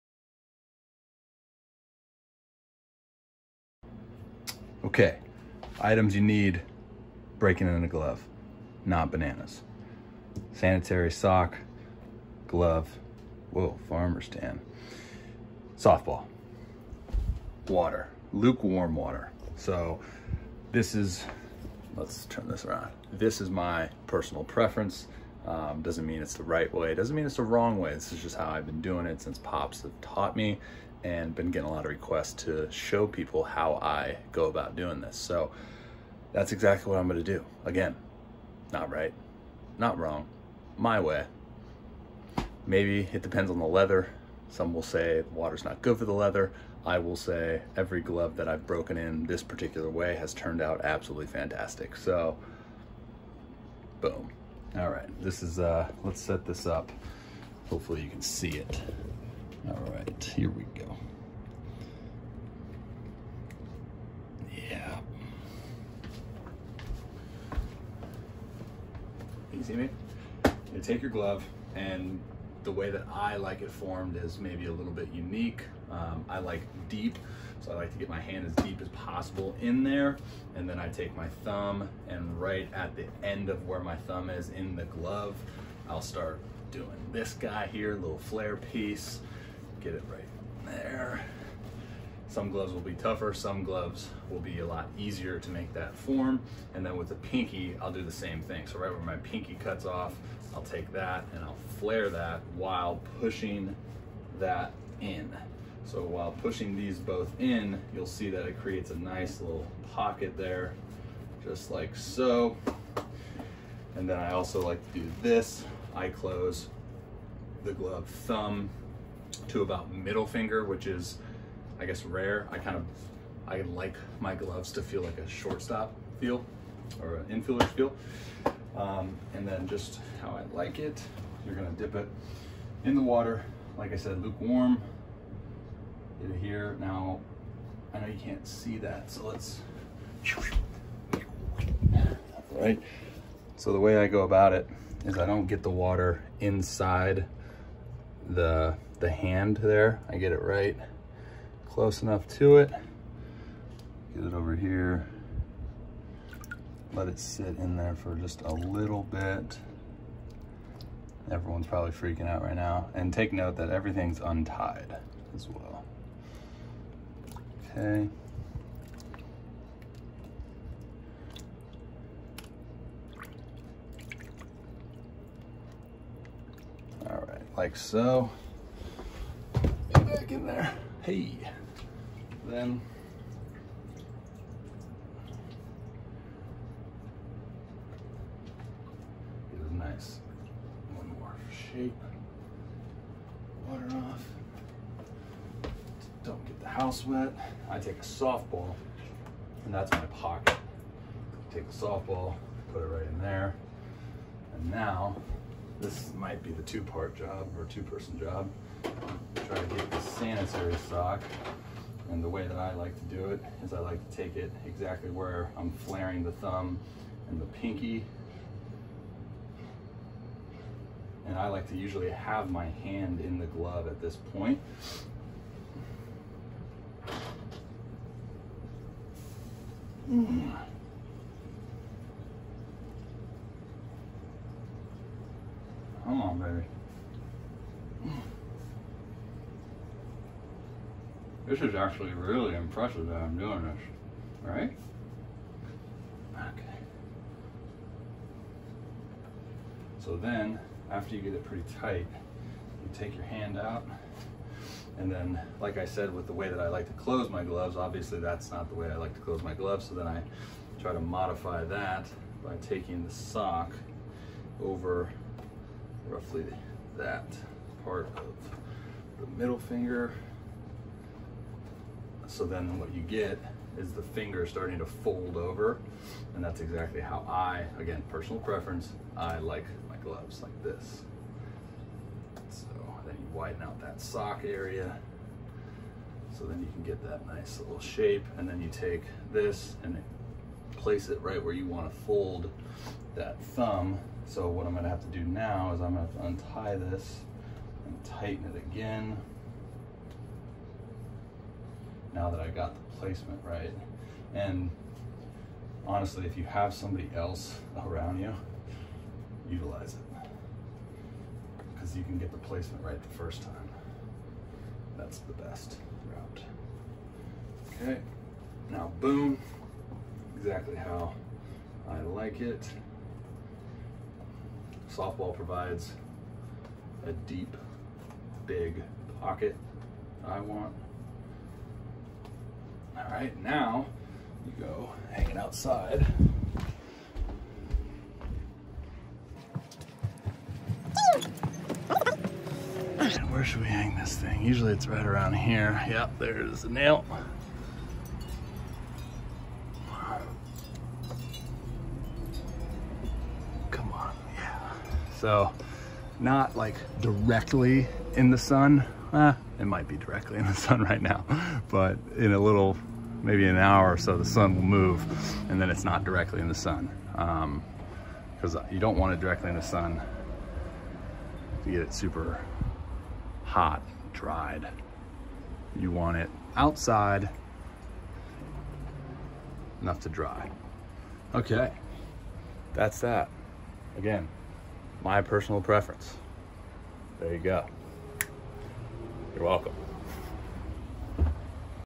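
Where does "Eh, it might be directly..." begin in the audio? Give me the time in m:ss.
5:59.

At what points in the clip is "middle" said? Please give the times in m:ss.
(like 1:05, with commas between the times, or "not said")
1:59, 4:29.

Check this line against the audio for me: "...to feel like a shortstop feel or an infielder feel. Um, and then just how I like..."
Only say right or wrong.
right.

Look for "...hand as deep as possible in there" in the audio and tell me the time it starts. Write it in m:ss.
1:18.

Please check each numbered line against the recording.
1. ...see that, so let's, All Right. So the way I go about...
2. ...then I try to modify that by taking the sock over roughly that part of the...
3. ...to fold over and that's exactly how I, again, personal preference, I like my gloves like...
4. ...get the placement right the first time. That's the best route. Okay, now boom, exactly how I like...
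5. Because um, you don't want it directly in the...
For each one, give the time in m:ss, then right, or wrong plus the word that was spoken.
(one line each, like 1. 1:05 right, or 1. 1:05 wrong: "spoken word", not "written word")
1. 2:18 right
2. 4:19 right
3. 4:34 right
4. 5:12 right
5. 6:07 right.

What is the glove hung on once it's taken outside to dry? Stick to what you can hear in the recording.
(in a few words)
A nail.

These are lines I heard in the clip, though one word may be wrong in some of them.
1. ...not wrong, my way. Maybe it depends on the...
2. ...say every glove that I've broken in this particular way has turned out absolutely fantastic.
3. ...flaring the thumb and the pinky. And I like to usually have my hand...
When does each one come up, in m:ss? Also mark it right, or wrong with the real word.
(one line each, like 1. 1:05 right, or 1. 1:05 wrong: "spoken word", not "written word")
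1. 0:39 right
2. 0:47 right
3. 3:35 right.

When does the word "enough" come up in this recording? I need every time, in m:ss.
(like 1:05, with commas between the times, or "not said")
2:32, 6:19.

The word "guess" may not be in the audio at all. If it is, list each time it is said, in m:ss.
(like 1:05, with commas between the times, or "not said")
2:01.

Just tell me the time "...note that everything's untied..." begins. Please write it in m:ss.
2:43.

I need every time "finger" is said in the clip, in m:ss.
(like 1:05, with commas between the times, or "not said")
2:00, 4:29, 4:34.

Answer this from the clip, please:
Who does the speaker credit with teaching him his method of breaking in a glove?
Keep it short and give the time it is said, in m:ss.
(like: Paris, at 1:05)
Pops, at 0:29.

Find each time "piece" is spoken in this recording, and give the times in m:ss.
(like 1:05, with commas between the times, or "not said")
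1:28.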